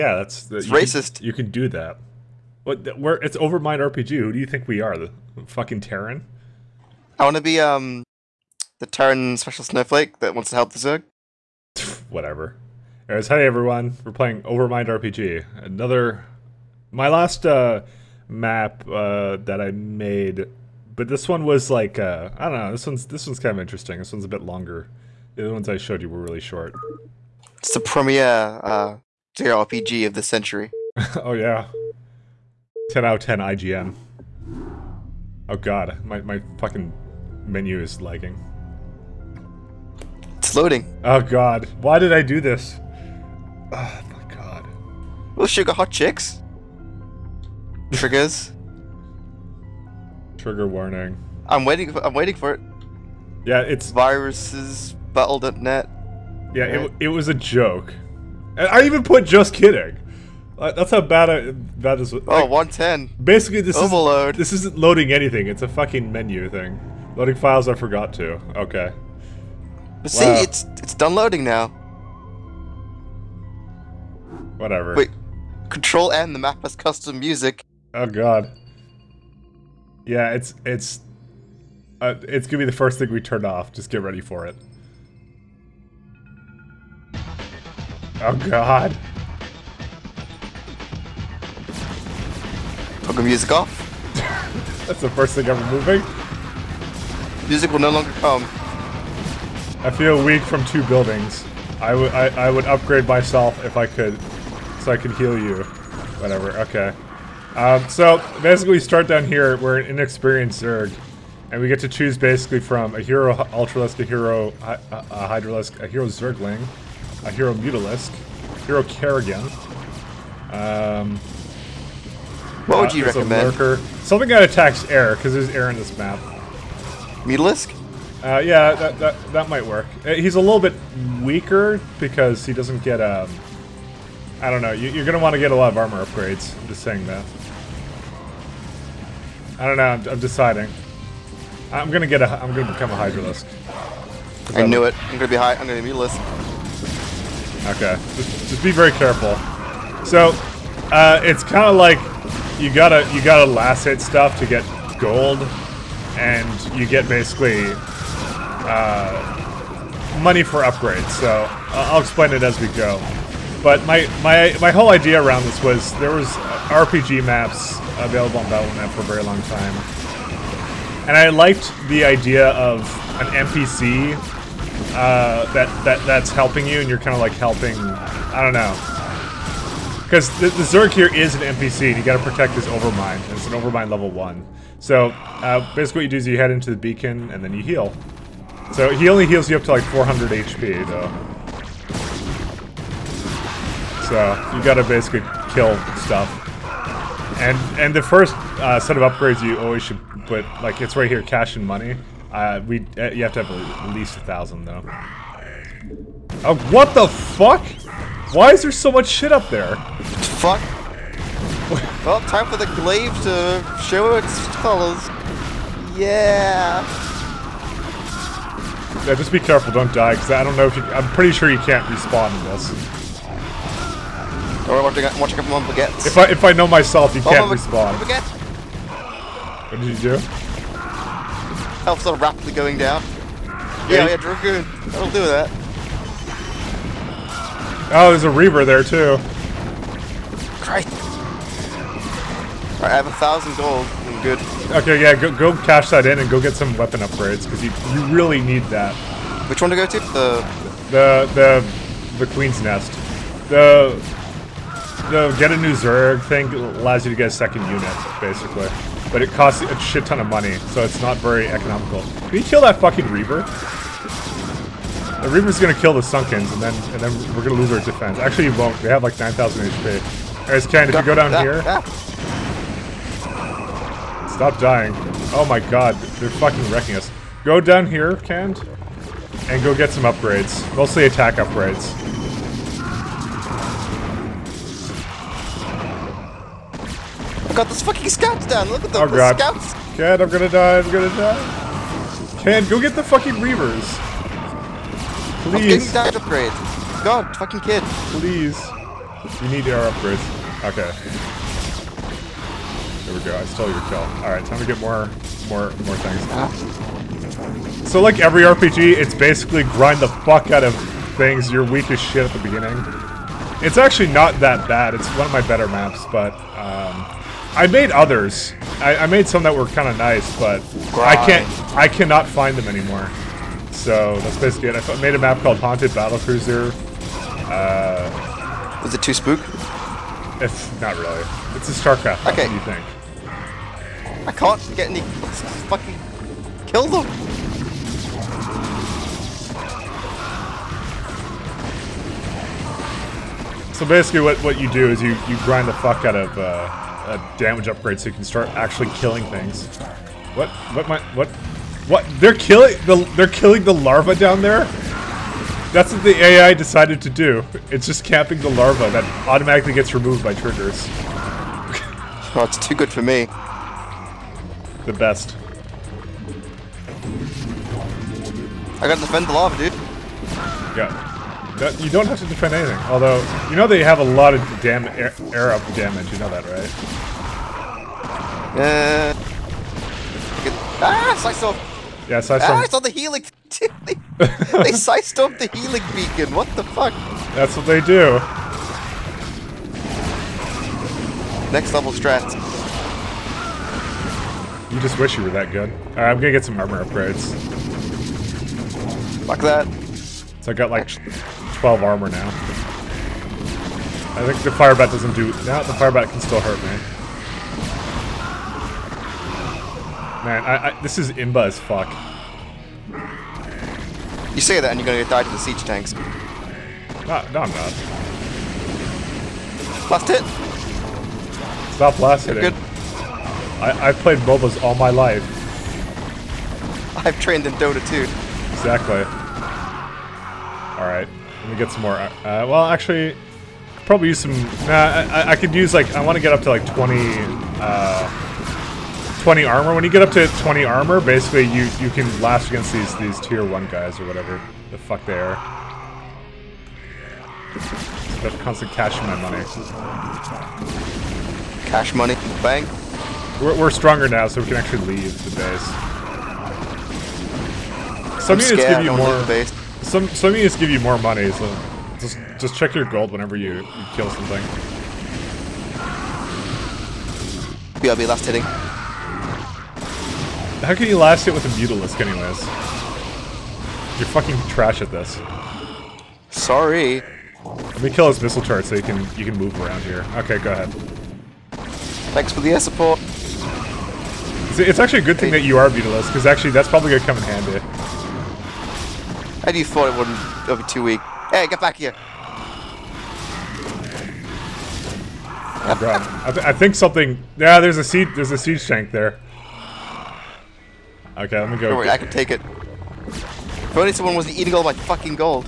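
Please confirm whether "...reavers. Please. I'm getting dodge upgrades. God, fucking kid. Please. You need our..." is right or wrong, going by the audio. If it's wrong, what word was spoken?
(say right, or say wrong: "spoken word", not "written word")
right.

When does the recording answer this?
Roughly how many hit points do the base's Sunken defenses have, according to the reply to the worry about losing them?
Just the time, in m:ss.
4:29.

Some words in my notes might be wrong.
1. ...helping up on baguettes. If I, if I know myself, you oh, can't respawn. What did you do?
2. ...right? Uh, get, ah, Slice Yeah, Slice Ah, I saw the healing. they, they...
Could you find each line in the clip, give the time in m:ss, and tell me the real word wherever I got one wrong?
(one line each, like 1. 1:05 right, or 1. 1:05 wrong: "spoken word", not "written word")
1. 3:45 wrong: "watching", not "helping"
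2. 6:16 right.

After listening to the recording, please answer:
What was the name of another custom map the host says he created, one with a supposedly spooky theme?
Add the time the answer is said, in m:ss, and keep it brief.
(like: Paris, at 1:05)
Haunted Battle Cruiser, at 5:25.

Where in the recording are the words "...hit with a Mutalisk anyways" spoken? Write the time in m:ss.
7:51.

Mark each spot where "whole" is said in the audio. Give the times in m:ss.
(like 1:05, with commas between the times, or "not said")
2:44.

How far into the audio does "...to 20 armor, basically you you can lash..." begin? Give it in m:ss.
7:20.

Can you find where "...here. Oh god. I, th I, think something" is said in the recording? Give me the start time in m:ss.
8:11.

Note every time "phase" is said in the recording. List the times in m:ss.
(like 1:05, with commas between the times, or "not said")
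not said.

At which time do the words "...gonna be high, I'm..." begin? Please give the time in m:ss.
2:25.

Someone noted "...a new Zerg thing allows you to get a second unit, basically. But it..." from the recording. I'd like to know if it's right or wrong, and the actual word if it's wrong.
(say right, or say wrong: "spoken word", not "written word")
right.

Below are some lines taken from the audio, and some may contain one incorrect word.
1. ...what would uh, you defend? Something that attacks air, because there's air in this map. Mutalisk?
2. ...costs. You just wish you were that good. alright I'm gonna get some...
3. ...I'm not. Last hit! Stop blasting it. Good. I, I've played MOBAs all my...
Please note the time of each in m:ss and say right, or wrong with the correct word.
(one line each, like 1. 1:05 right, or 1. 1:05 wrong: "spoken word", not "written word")
1. 2:02 wrong: "recommend", not "defend"
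2. 6:31 wrong: "strats", not "costs"
3. 6:57 right.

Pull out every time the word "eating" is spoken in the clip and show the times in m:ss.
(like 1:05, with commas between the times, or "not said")
8:24.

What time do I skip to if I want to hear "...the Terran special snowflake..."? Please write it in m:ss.
0:08.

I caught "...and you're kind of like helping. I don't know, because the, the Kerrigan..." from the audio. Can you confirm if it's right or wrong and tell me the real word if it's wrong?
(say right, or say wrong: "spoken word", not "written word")
wrong: "Zerg", not "Kerrigan".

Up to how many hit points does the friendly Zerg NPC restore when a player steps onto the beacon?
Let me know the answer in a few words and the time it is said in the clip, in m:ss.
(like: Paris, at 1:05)
400, at 3:09.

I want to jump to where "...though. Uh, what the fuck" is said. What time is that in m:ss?
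3:24.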